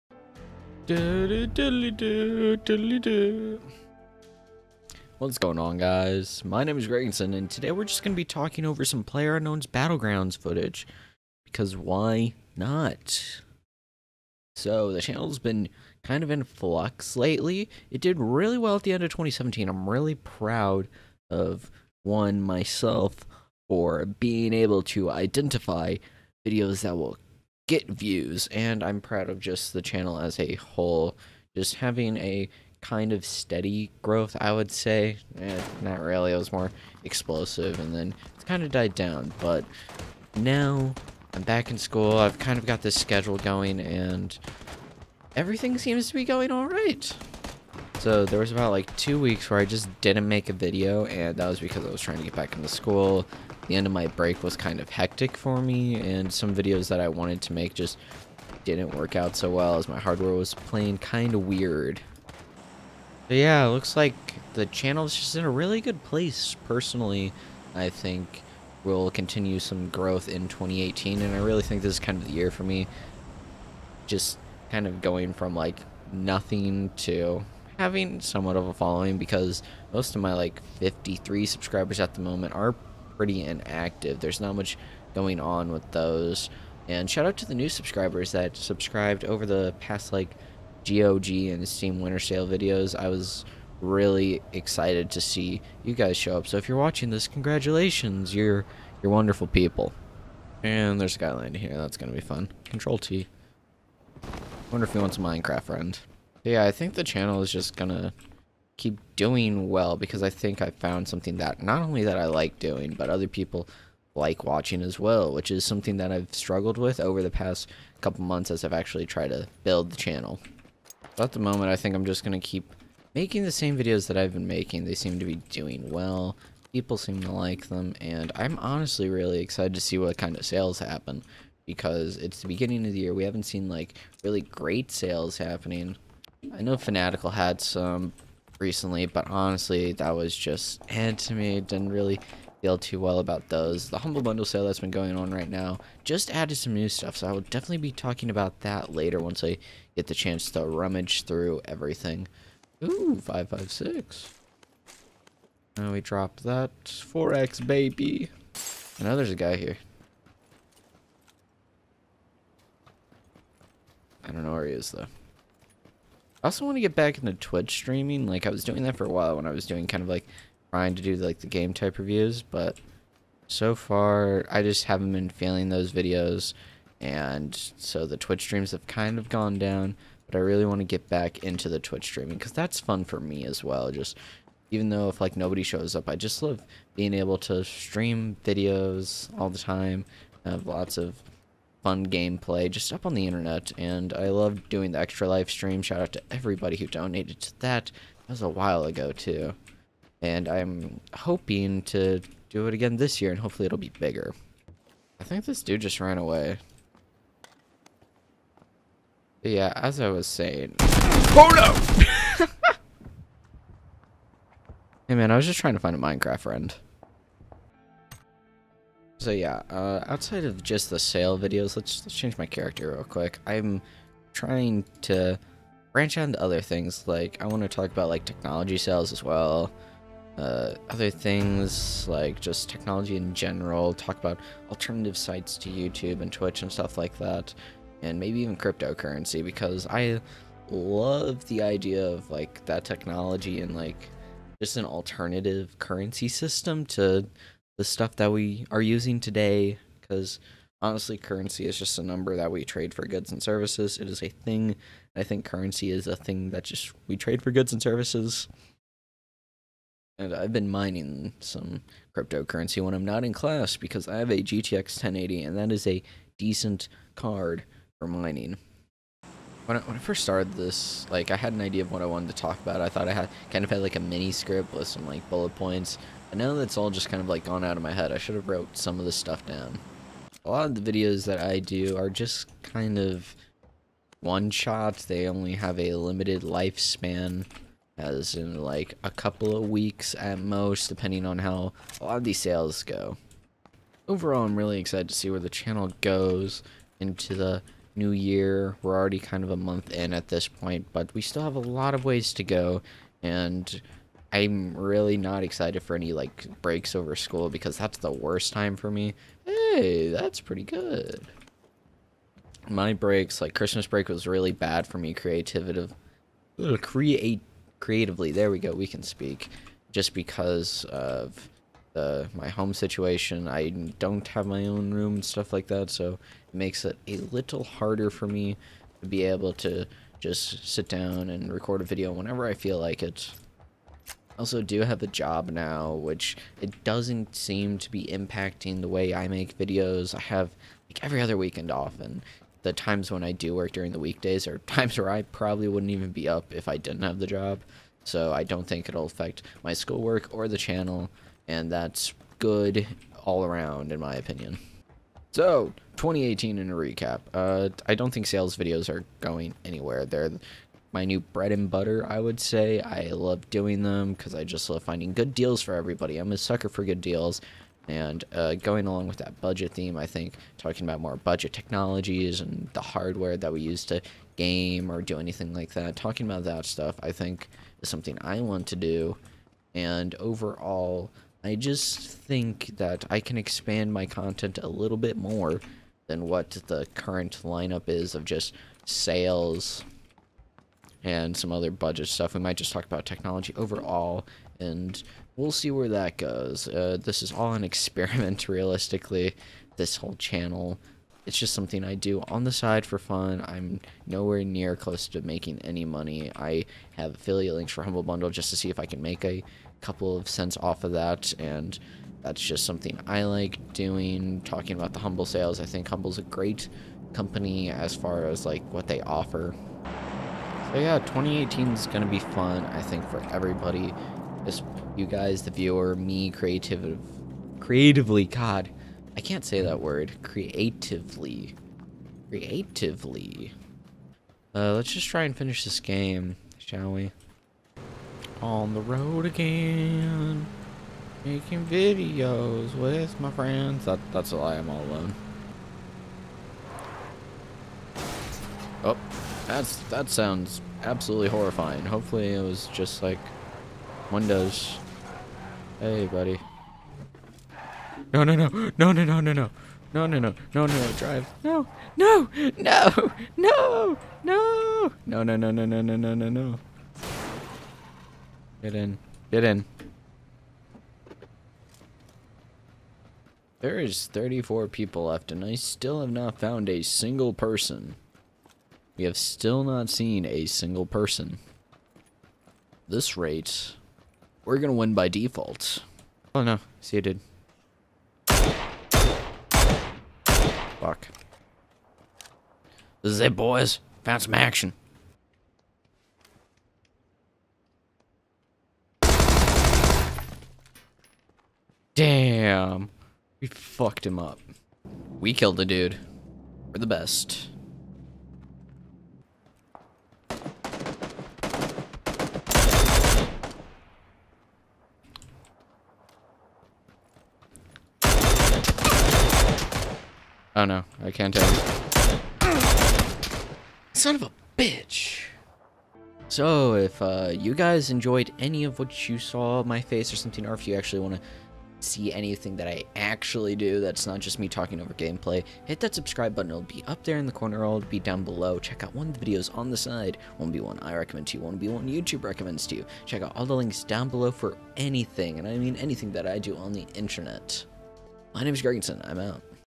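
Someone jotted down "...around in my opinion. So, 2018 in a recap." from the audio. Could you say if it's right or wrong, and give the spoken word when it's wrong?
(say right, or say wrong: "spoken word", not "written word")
right.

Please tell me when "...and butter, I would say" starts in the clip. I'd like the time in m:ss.
6:01.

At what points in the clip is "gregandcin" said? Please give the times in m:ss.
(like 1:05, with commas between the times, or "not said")
0:06, 9:08.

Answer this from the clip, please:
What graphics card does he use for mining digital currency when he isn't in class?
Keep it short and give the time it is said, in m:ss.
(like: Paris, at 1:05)
GTX 1080, at 4:24.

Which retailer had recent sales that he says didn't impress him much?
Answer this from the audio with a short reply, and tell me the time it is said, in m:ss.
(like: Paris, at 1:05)
Fanatical, at 2:16.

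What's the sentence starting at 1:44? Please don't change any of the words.
Wonder if he wants a Minecraft friend.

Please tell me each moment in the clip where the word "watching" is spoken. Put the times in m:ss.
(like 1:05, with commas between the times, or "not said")
1:36, 1:54.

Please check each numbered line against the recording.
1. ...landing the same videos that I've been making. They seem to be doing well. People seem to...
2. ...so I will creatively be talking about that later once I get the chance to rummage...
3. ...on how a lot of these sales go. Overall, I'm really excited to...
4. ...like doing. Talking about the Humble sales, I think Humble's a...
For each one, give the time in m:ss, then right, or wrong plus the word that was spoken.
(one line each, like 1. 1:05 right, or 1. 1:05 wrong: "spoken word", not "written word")
1. 2:03 wrong: "making", not "landing"
2. 2:27 wrong: "definitely", not "creatively"
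3. 4:51 right
4. 6:53 right.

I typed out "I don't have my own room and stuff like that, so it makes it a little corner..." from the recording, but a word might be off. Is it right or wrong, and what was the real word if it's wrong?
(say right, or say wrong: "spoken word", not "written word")
wrong: "harder", not "corner".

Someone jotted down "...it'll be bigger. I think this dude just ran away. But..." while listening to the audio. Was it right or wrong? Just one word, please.
right.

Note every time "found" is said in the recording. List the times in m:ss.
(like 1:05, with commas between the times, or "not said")
1:50, 7:56, 8:14.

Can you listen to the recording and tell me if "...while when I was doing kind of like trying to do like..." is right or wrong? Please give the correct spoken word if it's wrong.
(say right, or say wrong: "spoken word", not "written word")
right.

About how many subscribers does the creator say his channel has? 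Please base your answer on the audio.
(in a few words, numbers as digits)
53.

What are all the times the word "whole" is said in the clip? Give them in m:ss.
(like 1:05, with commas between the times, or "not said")
0:30, 6:39.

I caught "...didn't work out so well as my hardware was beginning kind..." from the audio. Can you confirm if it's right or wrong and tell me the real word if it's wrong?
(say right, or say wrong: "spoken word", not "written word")
wrong: "playing", not "beginning".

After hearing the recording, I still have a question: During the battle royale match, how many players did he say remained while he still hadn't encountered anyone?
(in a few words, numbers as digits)
34.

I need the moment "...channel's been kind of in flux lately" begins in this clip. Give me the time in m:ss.
0:15.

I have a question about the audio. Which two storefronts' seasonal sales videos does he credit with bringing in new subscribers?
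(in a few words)
GOG and Steam.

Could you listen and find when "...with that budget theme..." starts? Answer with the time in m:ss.
6:09.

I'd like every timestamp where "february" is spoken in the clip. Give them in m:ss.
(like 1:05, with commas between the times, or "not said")
not said.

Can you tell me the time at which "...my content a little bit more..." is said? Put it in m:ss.
6:23.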